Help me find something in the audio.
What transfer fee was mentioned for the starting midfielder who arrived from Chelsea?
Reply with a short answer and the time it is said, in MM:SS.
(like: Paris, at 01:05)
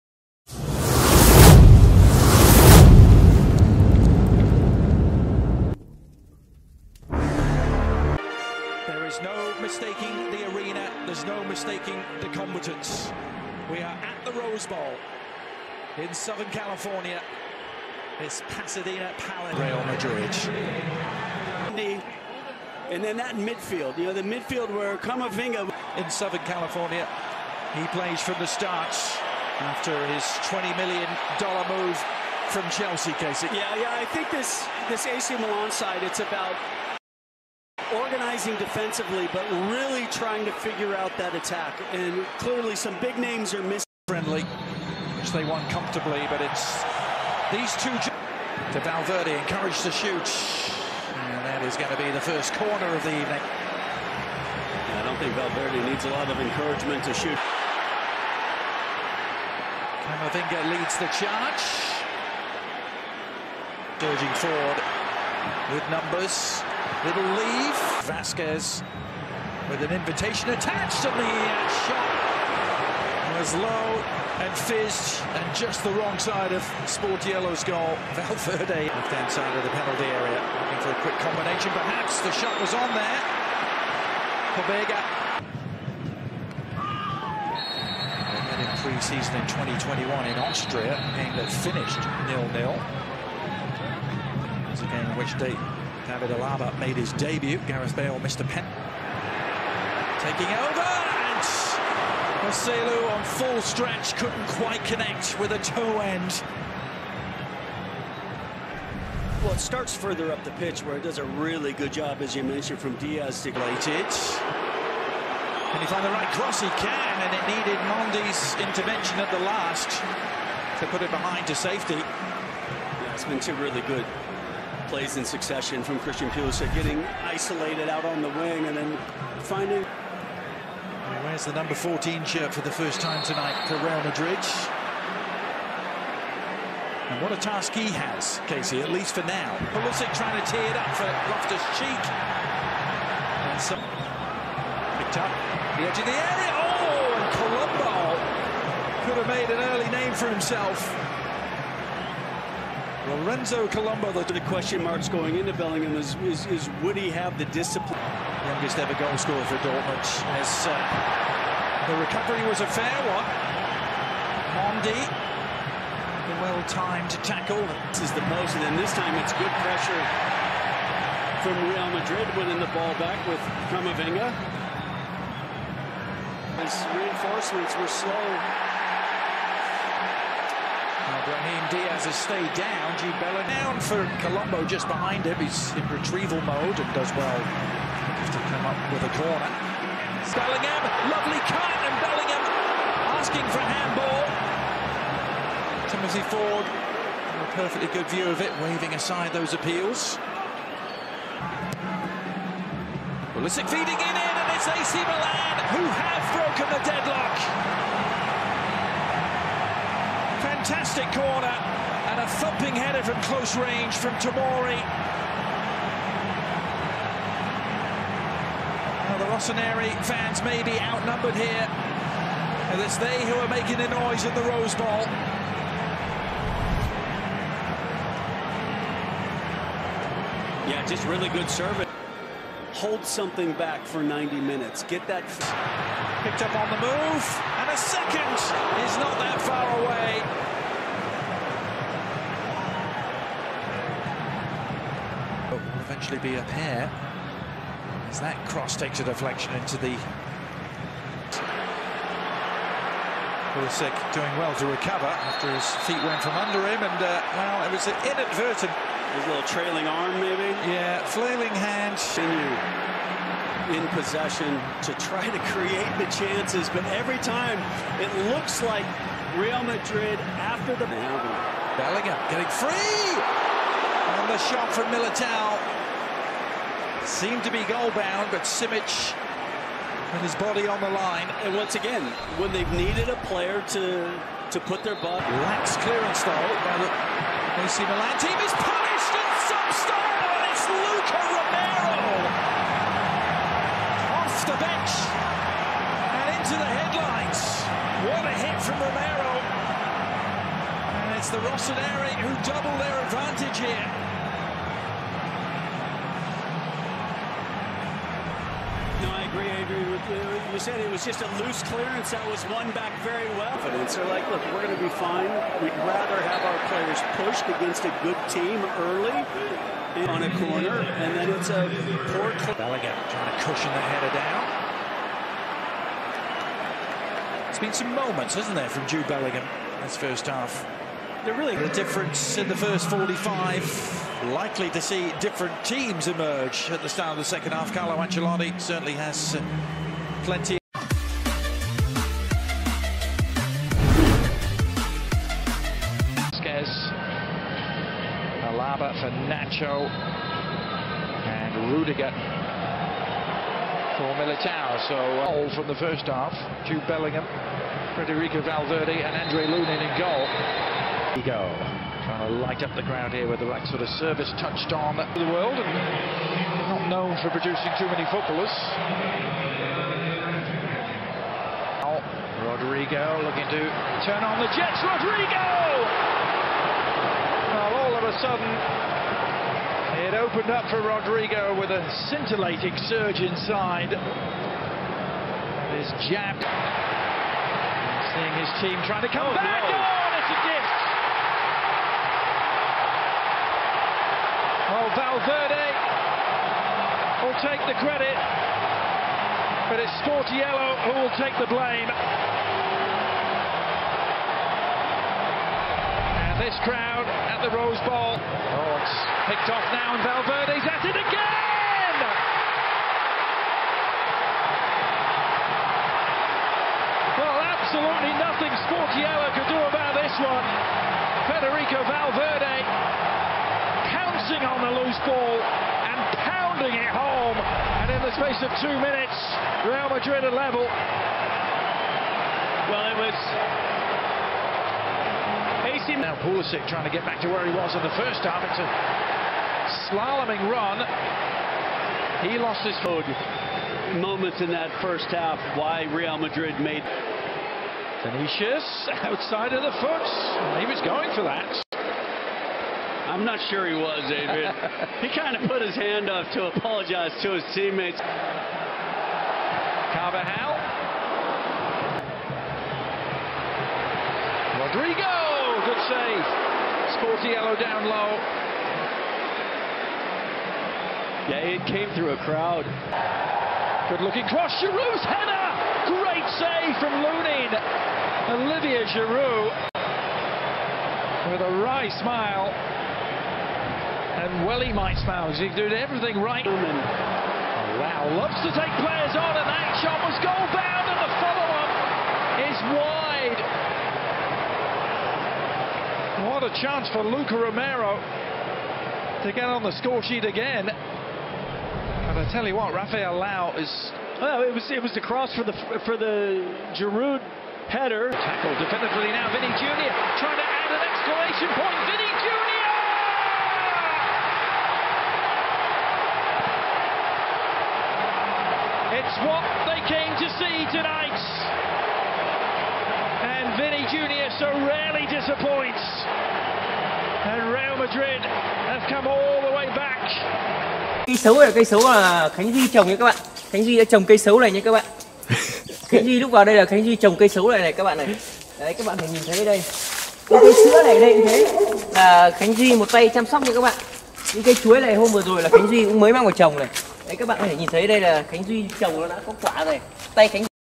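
$20 million, at 00:30.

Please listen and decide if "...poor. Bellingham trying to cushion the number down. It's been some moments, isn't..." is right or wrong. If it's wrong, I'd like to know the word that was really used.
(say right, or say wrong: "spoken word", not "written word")
wrong: "header", not "number".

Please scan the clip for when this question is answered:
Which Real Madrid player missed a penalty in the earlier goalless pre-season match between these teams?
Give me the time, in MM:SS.
01:37.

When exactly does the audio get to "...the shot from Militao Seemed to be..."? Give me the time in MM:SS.
04:34.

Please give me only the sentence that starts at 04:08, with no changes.
As that cross takes a deflection into the...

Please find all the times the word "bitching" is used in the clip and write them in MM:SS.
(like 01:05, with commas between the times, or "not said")
not said.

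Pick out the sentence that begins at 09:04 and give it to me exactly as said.
Những cây chuối này hôm vừa rồi là Khánh Duy cũng mới mang vào trồng này.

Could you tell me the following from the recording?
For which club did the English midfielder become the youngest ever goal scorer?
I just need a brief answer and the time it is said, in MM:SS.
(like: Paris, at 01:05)
Dortmund, at 02:39.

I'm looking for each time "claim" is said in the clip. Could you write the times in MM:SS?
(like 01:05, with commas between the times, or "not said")
not said.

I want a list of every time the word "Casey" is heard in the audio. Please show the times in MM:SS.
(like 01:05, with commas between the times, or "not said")
00:33, 02:18.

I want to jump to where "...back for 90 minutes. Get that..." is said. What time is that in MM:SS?
03:53.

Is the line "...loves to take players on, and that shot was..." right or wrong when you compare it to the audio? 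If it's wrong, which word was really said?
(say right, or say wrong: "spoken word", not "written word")
right.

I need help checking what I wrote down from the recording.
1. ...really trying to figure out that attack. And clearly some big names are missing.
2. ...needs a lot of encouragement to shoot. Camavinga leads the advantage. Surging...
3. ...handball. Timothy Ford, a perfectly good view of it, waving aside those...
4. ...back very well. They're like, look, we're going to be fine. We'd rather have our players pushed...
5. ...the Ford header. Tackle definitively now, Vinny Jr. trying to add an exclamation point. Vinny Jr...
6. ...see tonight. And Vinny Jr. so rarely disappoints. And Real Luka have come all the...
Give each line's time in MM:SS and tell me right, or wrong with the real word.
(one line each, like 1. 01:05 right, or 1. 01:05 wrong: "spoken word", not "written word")
1. 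00:39 right
2. 00:55 wrong: "charge", not "advantage"
3. 03:13 right
4. 05:12 right
5. 08:25 wrong: "Giroud", not "Ford"
6. 08:40 wrong: "Madrid", not "Luka".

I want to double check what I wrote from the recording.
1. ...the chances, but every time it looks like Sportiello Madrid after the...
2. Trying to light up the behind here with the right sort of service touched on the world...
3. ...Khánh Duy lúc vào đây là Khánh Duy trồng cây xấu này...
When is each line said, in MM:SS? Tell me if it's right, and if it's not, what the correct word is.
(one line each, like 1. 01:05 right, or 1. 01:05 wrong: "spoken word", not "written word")
1. 04:25 wrong: "Real", not "Sportiello"
2. 06:02 wrong: "ground", not "behind"
3. 08:55 right.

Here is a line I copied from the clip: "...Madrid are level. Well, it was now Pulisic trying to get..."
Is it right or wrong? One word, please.
right.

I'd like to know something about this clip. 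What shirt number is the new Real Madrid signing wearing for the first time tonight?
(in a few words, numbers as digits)
14.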